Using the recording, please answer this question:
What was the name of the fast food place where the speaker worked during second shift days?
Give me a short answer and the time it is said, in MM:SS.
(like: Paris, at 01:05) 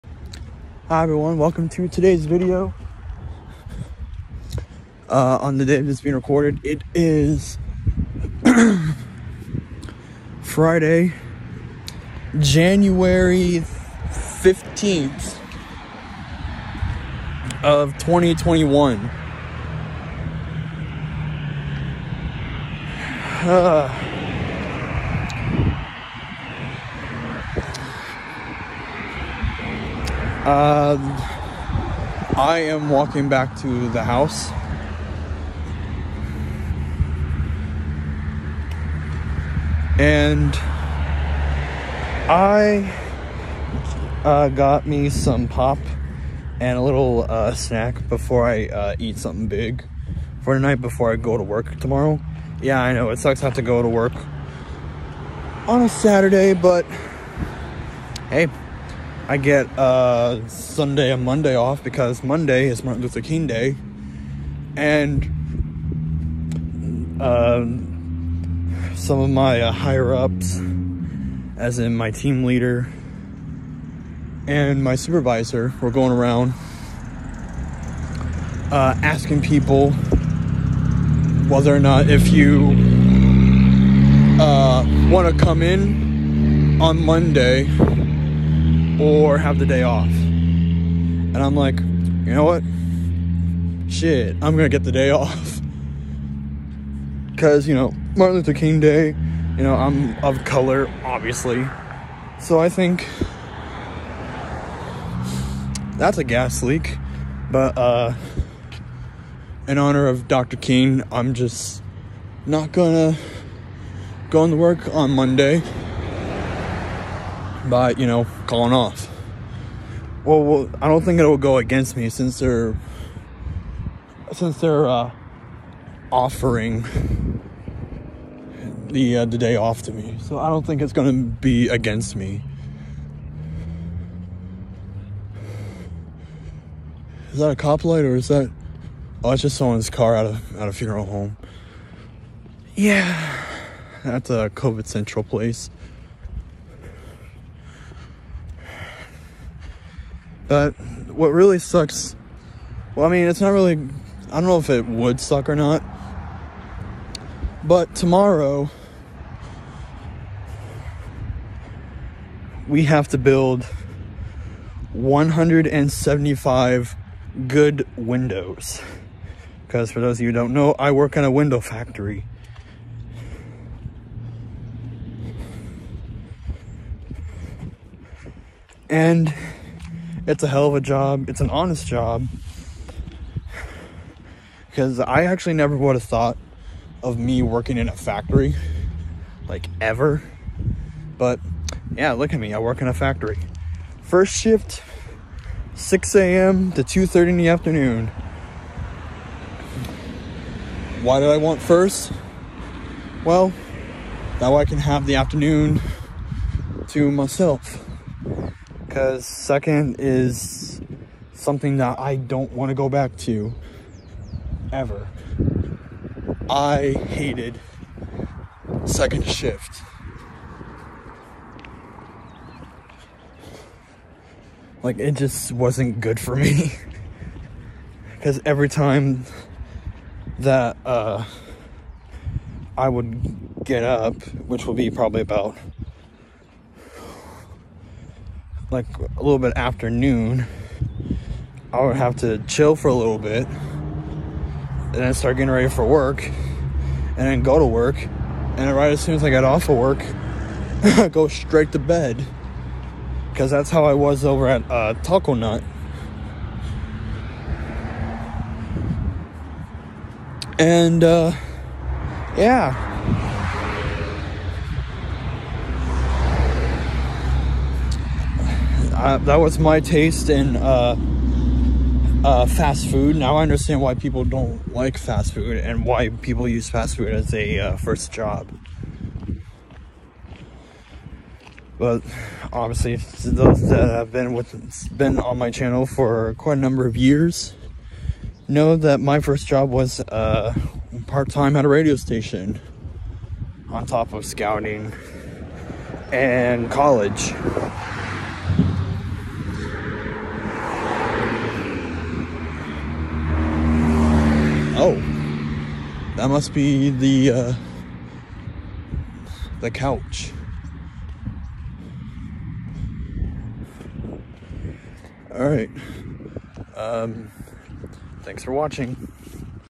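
Taco Nut, at 04:15.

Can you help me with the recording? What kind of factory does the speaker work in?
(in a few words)
Window factory.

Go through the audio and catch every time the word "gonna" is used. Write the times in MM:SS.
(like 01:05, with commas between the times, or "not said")
01:34, 01:52.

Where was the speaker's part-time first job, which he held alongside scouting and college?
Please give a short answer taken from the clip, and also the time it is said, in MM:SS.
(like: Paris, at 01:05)
Radio station, at 04:51.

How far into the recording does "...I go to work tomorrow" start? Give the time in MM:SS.
00:51.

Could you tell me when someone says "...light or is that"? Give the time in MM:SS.
02:17.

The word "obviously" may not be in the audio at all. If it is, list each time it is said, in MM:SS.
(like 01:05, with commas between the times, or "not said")
01:41, 04:42.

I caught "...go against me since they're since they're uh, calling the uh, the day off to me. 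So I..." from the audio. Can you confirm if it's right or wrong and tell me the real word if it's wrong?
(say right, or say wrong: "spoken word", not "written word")
wrong: "offering", not "calling".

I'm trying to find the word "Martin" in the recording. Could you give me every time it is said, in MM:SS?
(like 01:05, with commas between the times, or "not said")
01:02, 01:38.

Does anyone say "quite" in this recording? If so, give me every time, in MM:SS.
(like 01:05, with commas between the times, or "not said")
04:46.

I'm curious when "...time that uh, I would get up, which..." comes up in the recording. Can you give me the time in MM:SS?
03:48.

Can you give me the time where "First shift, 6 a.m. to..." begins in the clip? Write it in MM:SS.
03:14.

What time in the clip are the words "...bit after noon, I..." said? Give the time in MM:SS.
03:59.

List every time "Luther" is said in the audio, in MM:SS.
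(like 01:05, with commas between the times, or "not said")
01:03, 01:38.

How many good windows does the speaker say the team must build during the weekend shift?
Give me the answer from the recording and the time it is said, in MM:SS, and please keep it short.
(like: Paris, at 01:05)
175, at 02:44.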